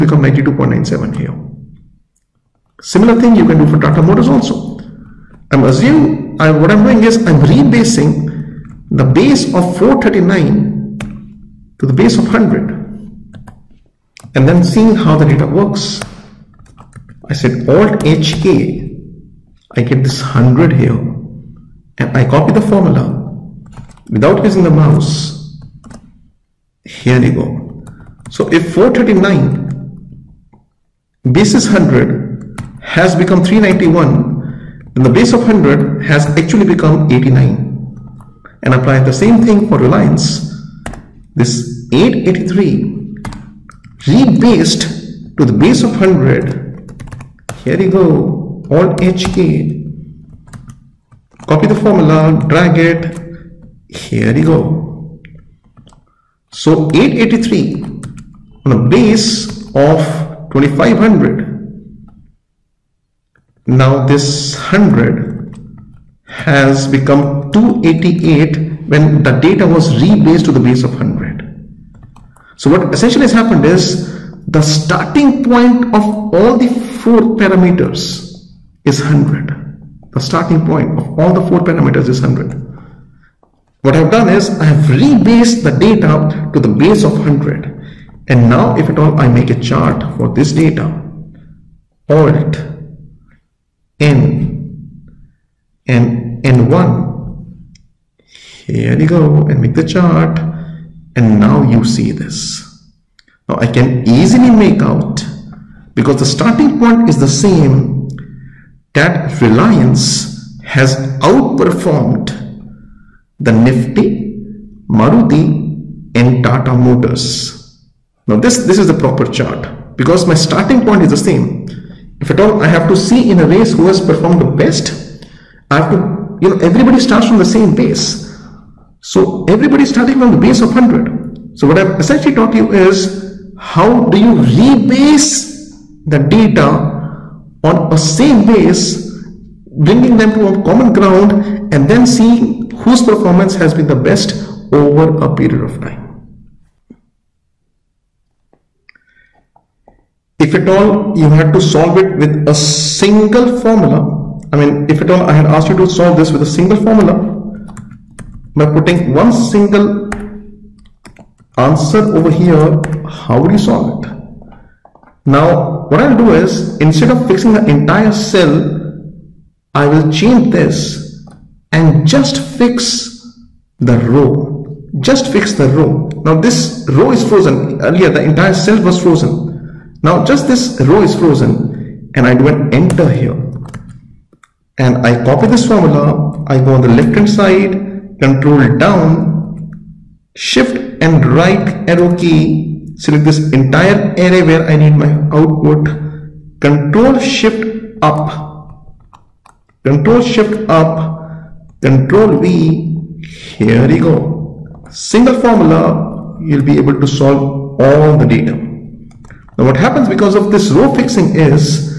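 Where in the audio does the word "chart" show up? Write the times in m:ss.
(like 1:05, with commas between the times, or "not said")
1:29, 1:39, 1:59.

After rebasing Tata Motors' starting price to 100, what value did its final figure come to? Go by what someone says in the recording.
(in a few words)
89.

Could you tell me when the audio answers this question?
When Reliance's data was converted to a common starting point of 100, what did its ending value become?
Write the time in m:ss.
1:07.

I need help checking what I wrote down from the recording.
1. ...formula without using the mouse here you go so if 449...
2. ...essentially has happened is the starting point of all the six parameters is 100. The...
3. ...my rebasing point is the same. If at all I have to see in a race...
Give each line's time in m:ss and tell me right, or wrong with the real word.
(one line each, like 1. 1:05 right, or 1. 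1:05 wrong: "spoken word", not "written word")
1. 0:22 wrong: "439", not "449"
2. 1:12 wrong: "four", not "six"
3. 2:00 wrong: "starting", not "rebasing".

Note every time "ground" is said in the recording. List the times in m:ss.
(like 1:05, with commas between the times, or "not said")
2:20.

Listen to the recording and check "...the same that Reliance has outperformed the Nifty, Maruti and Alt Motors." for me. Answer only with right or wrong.
wrong.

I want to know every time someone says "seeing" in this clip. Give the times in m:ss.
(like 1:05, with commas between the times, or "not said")
0:14, 2:22.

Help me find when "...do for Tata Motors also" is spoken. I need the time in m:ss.
0:03.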